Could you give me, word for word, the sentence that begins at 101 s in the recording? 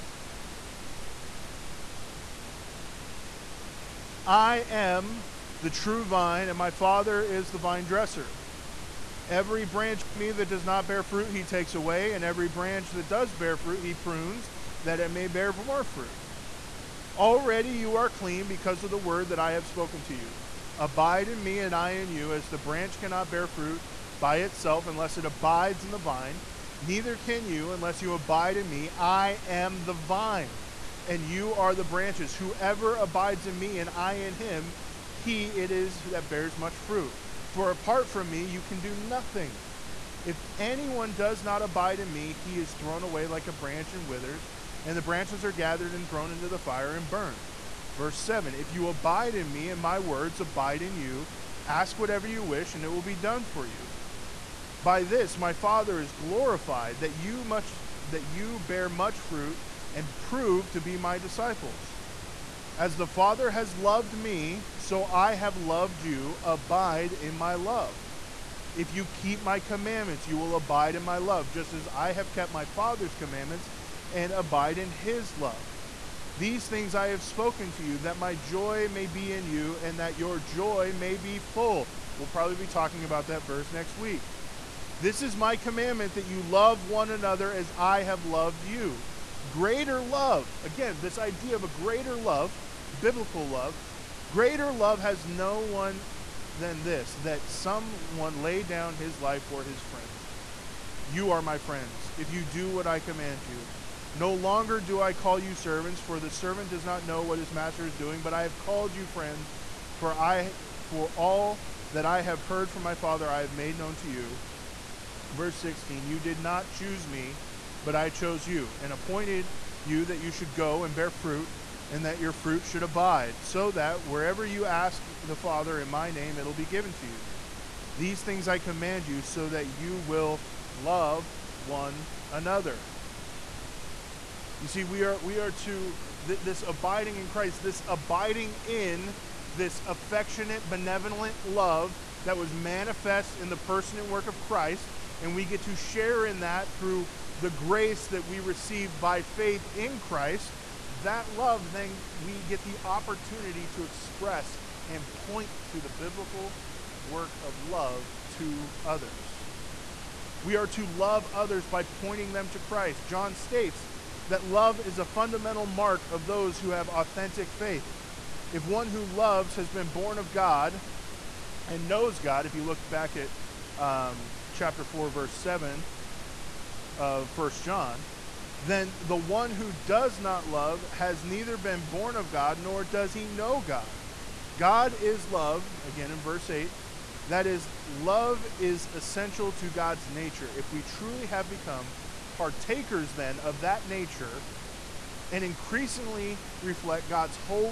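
You are my friends if you do what I command you.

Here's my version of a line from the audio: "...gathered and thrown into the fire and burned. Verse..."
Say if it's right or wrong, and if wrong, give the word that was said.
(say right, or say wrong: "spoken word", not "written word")
right.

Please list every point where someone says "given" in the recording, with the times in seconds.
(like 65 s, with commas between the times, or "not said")
126 s.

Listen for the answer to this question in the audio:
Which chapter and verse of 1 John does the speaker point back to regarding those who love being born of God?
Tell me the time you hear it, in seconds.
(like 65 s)
174 s.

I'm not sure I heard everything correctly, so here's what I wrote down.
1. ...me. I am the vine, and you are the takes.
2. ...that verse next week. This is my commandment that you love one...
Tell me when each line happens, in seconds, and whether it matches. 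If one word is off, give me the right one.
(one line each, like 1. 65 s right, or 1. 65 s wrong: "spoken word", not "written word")
1. 28 s wrong: "branches", not "takes"
2. 83 s right.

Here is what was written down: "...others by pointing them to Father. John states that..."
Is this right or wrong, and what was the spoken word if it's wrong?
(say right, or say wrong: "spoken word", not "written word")
wrong: "Christ", not "Father".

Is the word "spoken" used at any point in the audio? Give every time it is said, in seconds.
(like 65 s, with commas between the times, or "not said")
19 s, 77 s.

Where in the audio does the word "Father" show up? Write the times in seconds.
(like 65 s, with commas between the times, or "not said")
6 s, 55 s, 63 s, 72 s, 112 s, 125 s.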